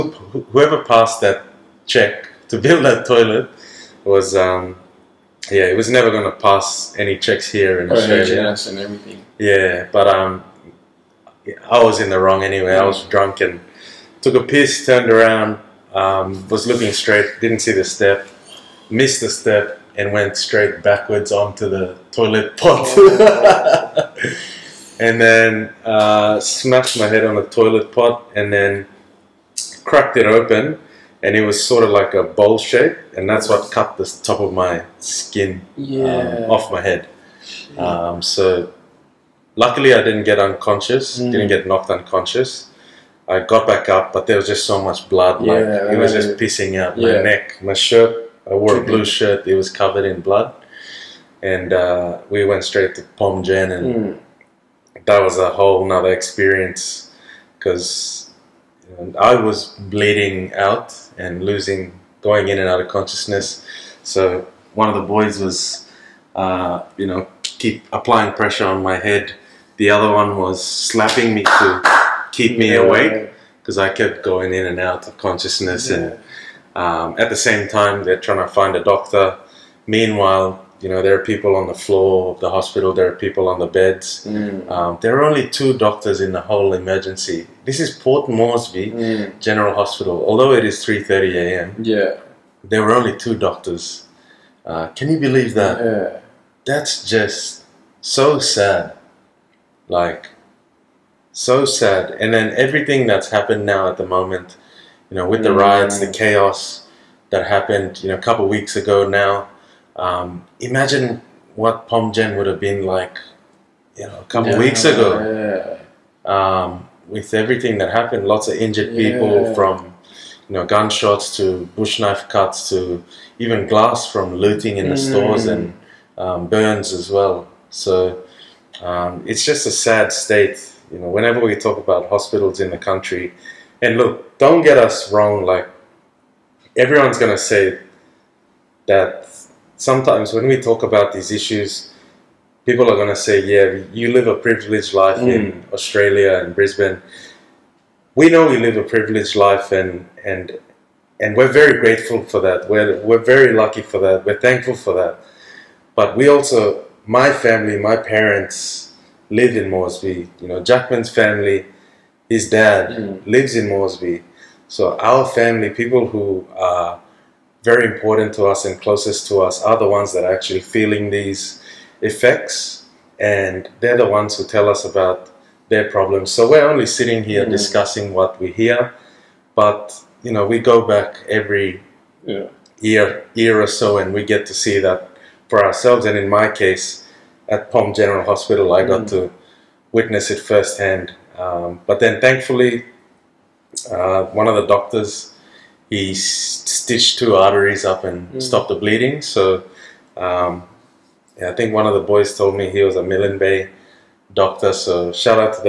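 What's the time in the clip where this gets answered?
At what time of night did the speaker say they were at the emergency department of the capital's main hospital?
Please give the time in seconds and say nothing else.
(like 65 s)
90 s.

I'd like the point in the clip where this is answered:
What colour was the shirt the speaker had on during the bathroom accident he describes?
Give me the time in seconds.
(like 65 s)
48 s.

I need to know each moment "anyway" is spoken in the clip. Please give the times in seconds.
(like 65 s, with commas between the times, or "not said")
12 s.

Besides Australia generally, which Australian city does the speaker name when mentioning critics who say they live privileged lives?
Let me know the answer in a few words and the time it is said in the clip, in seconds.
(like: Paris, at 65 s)
Brisbane, at 146 s.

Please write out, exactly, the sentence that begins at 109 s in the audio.
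Um, imagine what Pom Gen would have been like, you know, a couple yeah, weeks ago.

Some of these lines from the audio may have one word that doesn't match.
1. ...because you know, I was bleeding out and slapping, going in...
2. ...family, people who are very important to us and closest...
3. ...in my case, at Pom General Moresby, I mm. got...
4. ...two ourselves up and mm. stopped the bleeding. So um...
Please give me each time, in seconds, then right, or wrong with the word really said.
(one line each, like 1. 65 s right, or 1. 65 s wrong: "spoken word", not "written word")
1. 57 s wrong: "losing", not "slapping"
2. 165 s right
3. 186 s wrong: "Hospital", not "Moresby"
4. 197 s wrong: "arteries", not "ourselves".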